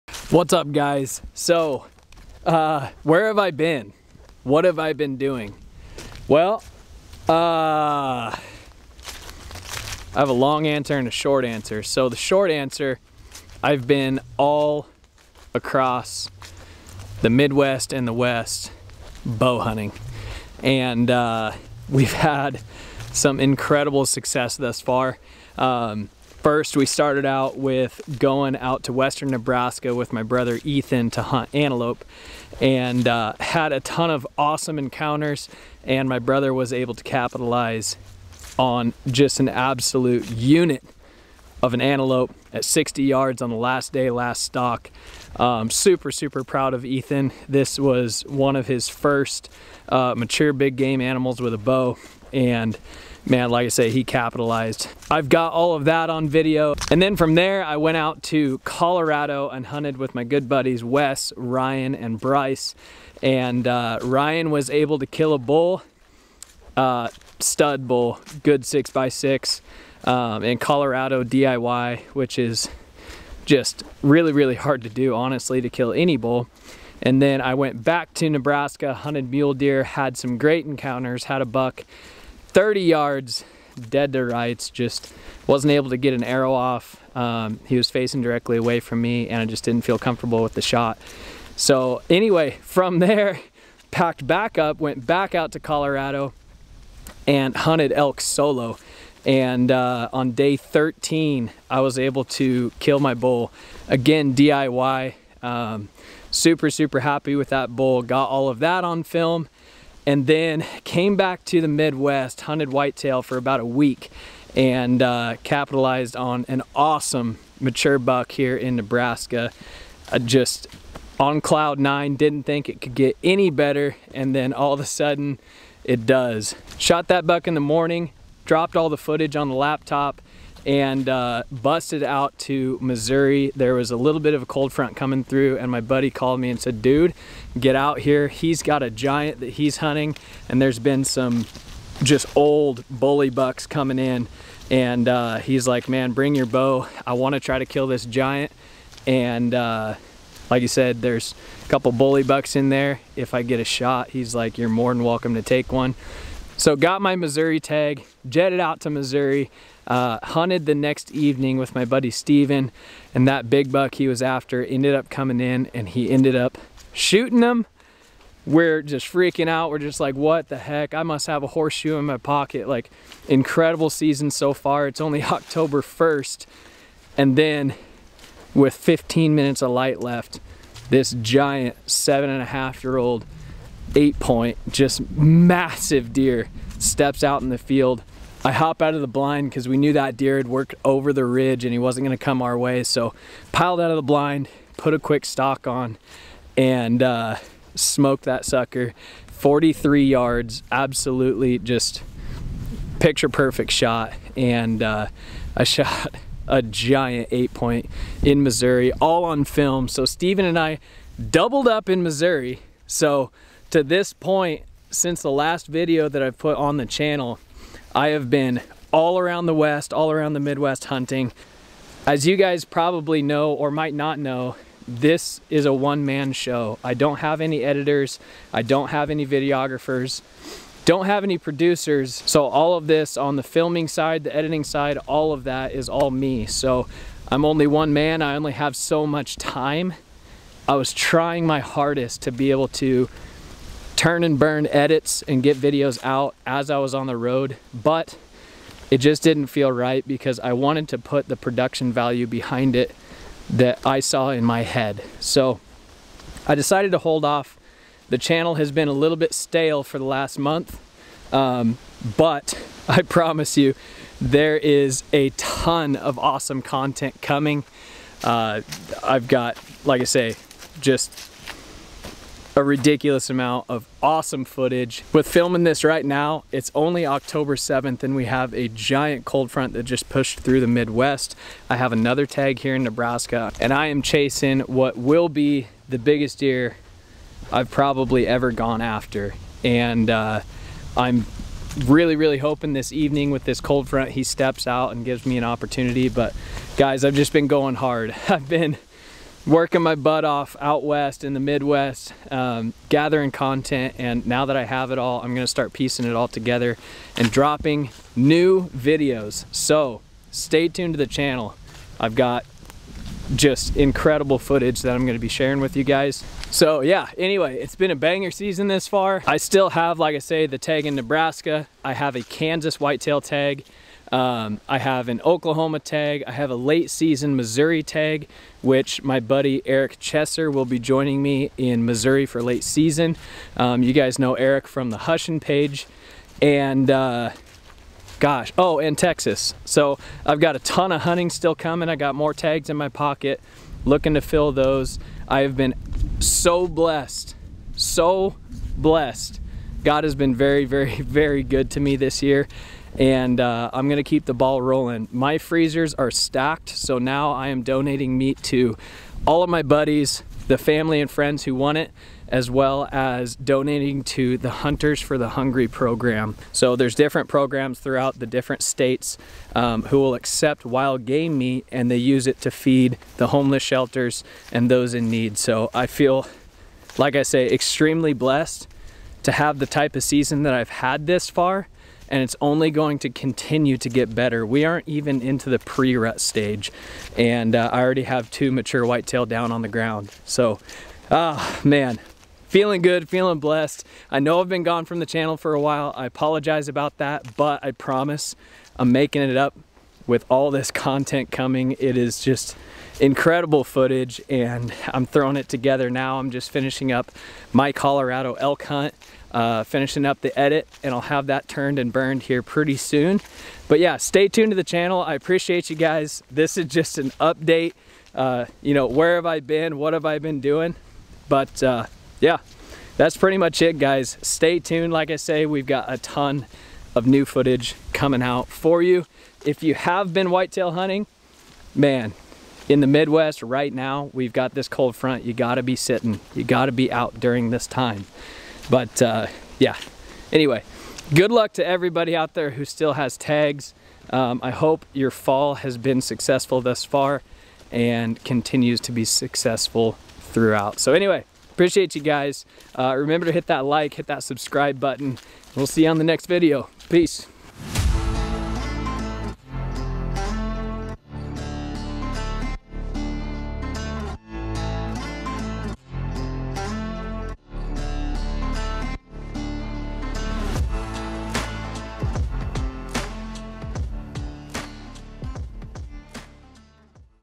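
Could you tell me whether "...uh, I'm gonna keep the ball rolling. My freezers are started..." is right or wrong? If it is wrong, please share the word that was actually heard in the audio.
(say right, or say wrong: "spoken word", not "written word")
wrong: "stocked", not "started".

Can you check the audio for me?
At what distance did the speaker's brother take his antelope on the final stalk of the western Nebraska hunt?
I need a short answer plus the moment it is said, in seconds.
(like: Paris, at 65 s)
60 yards, at 42 s.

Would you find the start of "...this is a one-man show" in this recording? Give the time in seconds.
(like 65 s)
224 s.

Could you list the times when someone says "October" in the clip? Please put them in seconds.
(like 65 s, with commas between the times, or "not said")
175 s, 277 s.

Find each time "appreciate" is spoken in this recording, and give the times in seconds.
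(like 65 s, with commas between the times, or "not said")
415 s, 451 s.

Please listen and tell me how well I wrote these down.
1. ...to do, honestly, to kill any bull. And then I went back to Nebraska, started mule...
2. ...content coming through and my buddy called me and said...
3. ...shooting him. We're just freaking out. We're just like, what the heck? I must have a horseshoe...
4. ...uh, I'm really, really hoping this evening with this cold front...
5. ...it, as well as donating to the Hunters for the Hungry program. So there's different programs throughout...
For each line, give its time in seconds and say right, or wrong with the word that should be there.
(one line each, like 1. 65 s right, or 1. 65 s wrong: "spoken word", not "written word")
1. 74 s wrong: "hunted", not "started"
2. 134 s wrong: "front", not "content"
3. 166 s right
4. 290 s right
5. 361 s right.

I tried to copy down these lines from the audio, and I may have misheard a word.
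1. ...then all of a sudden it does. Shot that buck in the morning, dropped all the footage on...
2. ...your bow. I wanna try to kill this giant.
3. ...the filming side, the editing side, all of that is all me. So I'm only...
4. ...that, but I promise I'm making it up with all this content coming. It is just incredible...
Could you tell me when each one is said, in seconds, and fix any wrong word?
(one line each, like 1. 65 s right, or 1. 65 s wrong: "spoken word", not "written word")
1. 124 s right
2. 146 s right
3. 233 s right
4. 396 s right.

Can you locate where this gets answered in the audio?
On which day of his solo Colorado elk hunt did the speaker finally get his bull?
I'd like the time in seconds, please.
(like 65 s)
100 s.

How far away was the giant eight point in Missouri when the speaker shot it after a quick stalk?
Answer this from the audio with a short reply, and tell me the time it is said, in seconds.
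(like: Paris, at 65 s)
43 yards, at 199 s.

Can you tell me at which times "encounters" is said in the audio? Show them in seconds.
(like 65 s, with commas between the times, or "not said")
34 s, 80 s.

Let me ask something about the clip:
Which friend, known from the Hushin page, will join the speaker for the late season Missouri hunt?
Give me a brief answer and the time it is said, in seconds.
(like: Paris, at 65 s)
Eric Chesser, at 329 s.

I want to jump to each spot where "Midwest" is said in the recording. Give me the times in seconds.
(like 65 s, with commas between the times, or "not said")
17 s, 111 s, 220 s, 280 s, 301 s, 432 s.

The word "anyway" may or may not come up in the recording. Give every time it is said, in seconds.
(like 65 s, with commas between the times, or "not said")
92 s, 317 s, 440 s, 450 s.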